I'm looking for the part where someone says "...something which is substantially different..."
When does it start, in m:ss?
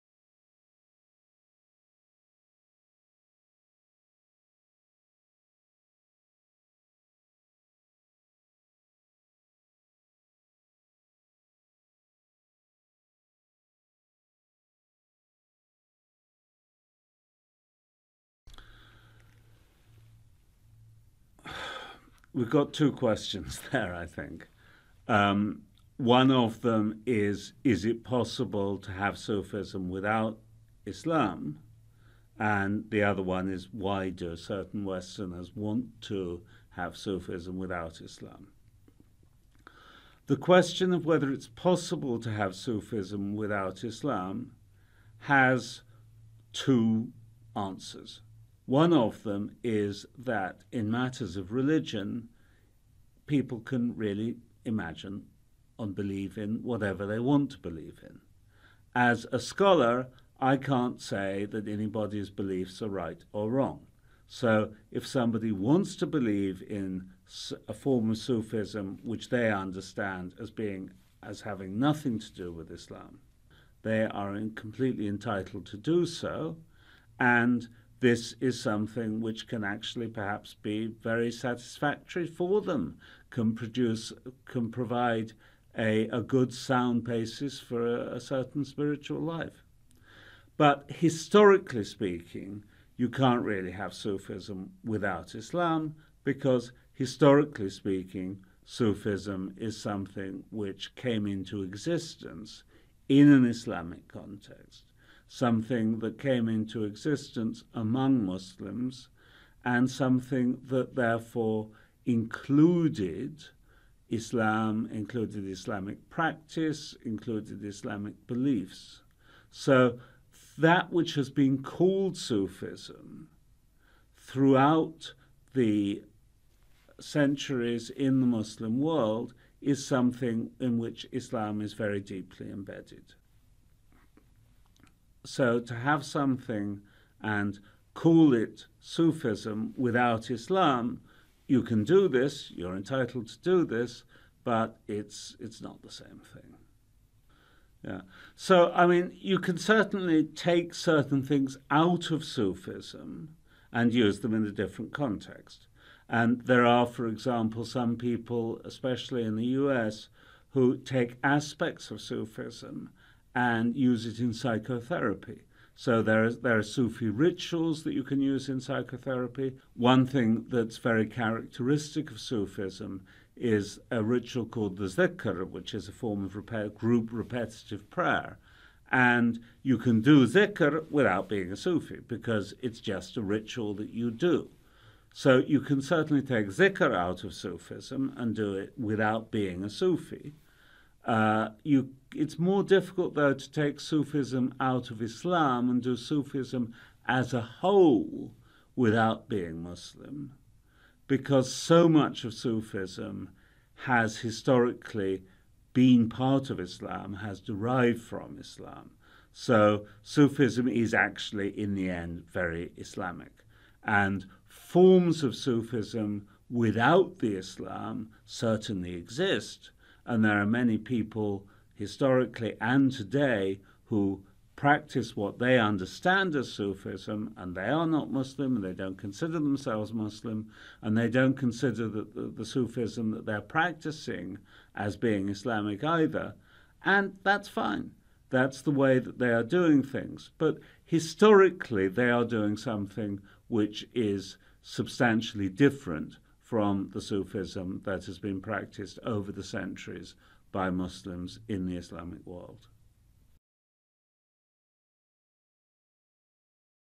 4:02.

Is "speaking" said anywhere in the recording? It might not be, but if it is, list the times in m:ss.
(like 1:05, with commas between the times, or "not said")
1:31, 1:37.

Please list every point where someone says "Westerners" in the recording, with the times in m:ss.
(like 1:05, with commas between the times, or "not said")
0:34.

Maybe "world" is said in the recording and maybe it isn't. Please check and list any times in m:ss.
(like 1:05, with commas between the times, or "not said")
2:08, 4:12.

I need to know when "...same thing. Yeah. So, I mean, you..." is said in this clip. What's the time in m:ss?
2:25.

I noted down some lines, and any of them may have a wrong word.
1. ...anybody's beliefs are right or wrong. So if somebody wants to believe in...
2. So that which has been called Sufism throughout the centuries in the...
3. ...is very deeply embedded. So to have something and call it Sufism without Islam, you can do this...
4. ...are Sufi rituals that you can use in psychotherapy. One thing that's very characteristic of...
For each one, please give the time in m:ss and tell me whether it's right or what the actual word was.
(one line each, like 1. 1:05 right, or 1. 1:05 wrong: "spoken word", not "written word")
1. 1:01 right
2. 1:59 right
3. 2:11 right
4. 2:46 right.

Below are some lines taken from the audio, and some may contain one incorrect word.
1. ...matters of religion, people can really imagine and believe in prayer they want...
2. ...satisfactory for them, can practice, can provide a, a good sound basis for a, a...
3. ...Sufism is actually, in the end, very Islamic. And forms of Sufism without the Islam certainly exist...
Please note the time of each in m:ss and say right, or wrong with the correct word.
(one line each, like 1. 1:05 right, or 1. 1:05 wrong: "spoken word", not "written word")
1. 0:50 wrong: "whatever", not "prayer"
2. 1:21 wrong: "produce", not "practice"
3. 3:30 right.